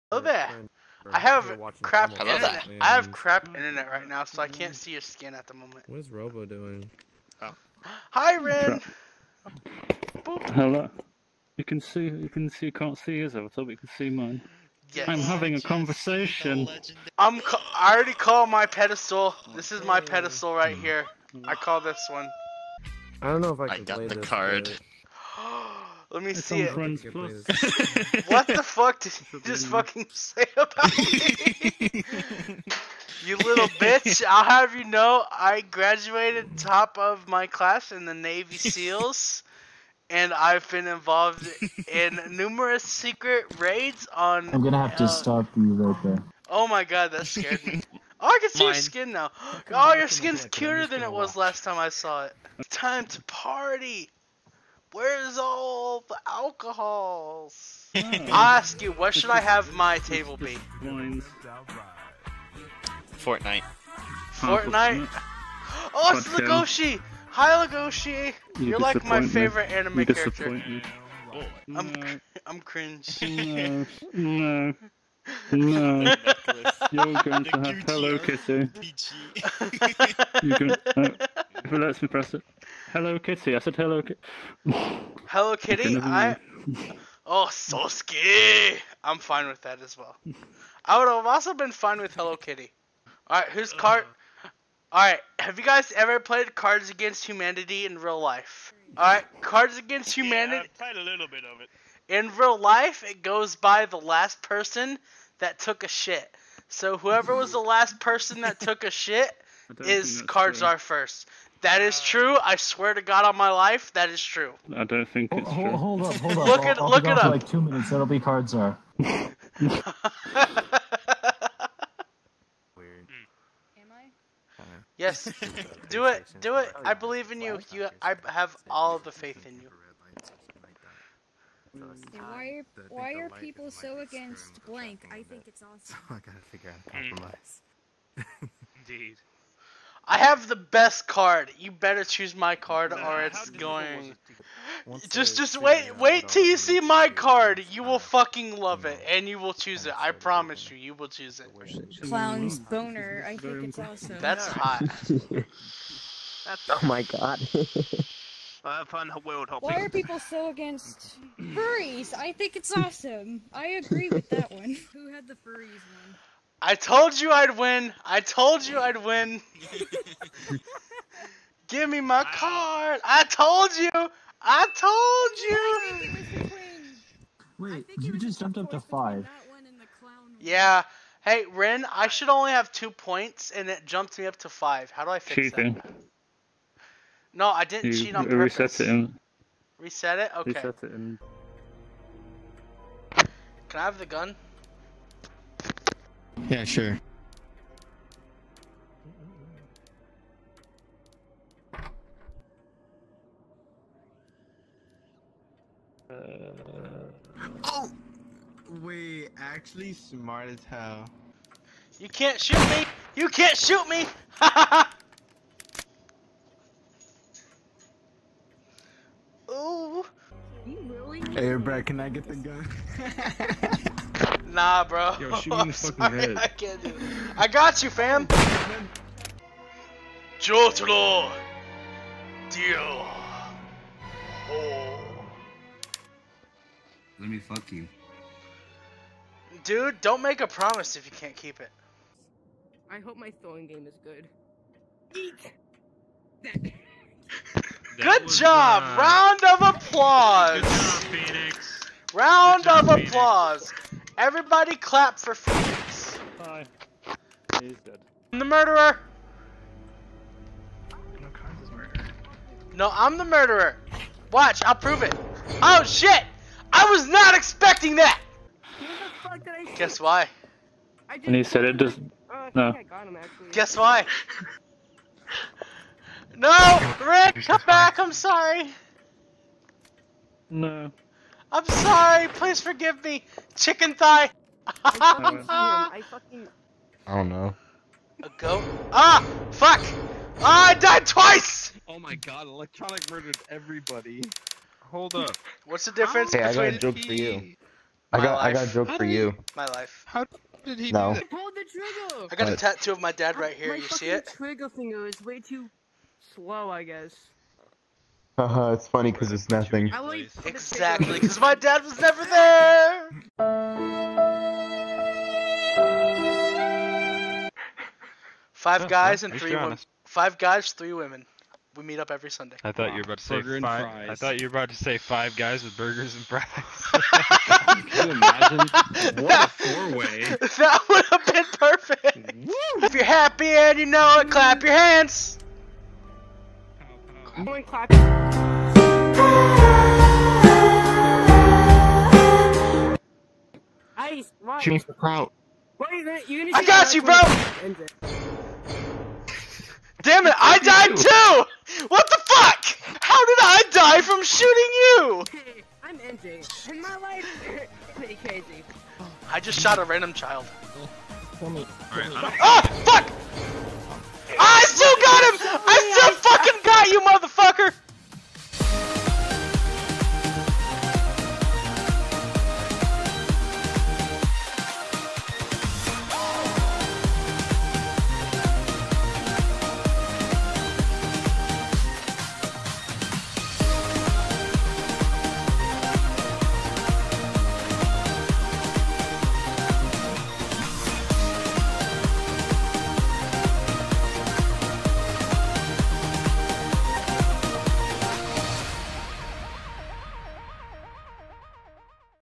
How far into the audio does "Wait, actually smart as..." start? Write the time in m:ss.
3:28.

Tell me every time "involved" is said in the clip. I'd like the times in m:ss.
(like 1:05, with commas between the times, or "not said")
0:40.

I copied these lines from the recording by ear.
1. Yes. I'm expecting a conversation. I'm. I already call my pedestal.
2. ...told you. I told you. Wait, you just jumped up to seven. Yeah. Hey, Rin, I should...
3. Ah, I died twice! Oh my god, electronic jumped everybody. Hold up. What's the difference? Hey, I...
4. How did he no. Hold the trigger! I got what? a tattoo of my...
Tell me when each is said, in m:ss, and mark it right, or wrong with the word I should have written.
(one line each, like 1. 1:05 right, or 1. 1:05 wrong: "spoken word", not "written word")
1. 0:14 wrong: "having", not "expecting"
2. 2:53 wrong: "five", not "seven"
3. 4:50 wrong: "murdered", not "jumped"
4. 5:00 right.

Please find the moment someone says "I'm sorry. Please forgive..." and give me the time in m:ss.
4:41.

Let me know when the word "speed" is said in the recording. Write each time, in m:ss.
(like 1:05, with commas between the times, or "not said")
not said.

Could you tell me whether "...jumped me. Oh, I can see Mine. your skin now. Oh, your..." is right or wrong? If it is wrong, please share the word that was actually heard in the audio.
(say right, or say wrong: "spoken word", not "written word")
wrong: "scared", not "jumped".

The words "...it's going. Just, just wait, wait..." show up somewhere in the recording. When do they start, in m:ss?
2:23.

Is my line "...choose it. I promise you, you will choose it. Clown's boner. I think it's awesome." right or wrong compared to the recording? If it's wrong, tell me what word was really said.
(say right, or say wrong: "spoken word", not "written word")
right.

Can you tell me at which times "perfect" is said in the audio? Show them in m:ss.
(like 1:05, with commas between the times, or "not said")
5:31.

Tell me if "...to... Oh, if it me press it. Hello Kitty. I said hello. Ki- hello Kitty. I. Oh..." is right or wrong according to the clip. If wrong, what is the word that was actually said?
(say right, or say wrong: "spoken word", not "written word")
right.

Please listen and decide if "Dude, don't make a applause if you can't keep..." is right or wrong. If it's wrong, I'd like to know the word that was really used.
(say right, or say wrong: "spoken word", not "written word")
wrong: "promise", not "applause".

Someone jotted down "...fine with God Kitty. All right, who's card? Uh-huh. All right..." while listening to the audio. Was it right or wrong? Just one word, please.
wrong.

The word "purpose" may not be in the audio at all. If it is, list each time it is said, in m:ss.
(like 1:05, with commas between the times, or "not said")
3:08.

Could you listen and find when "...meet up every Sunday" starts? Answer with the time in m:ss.
5:21.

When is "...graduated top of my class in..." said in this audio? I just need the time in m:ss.
0:35.